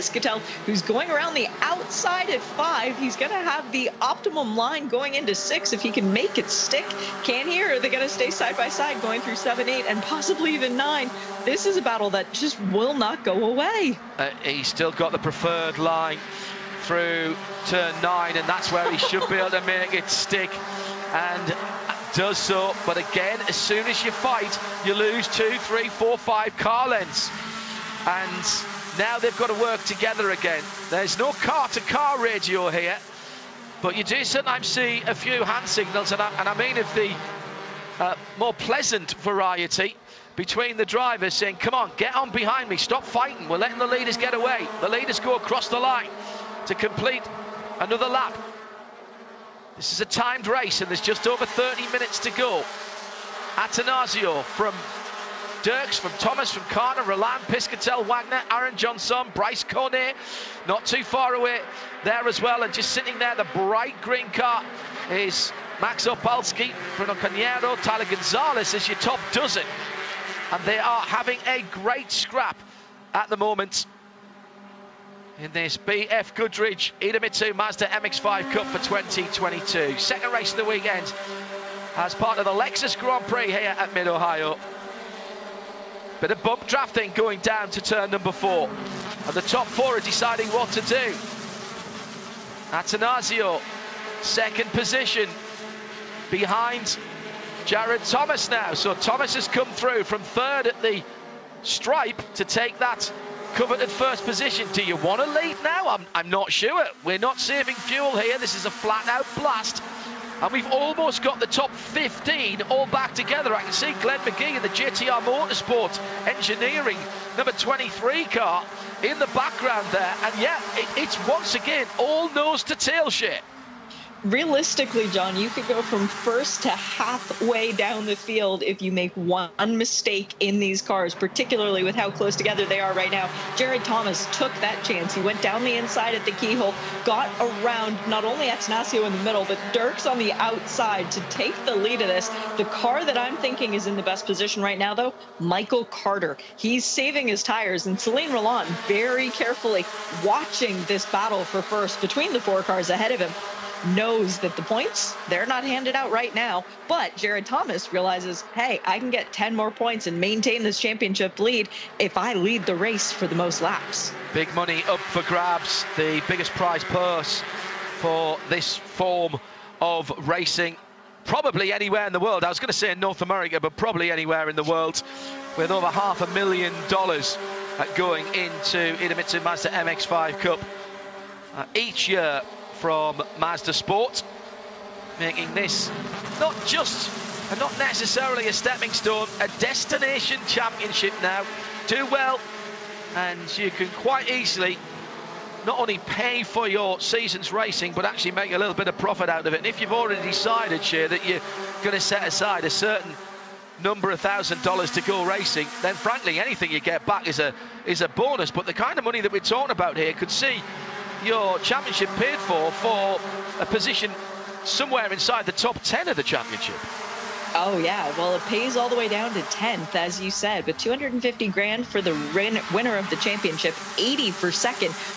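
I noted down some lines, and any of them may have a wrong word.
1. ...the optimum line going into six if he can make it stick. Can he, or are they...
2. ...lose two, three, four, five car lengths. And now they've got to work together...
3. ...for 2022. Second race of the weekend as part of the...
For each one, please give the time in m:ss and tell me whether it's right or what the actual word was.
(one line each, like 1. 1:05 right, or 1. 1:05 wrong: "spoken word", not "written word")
1. 0:03 right
2. 0:24 right
3. 1:18 right.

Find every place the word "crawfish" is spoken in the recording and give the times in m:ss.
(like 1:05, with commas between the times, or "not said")
not said.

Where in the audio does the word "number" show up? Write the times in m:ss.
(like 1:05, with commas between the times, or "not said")
1:28, 1:57, 3:23.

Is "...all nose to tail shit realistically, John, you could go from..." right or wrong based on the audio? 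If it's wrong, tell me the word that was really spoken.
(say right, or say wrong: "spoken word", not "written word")
right.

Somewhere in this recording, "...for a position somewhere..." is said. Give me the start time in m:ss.
3:32.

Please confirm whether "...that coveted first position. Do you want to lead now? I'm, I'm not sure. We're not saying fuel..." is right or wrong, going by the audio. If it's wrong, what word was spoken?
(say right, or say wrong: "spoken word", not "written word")
wrong: "saving", not "saying".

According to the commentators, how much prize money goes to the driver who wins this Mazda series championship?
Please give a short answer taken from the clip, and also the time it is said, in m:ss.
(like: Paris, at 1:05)
250 grand, at 3:40.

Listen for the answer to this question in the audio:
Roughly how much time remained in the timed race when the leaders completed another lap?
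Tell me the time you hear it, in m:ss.
0:51.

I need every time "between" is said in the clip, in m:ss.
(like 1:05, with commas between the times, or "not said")
0:40, 2:32.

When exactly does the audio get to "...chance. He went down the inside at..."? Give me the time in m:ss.
2:14.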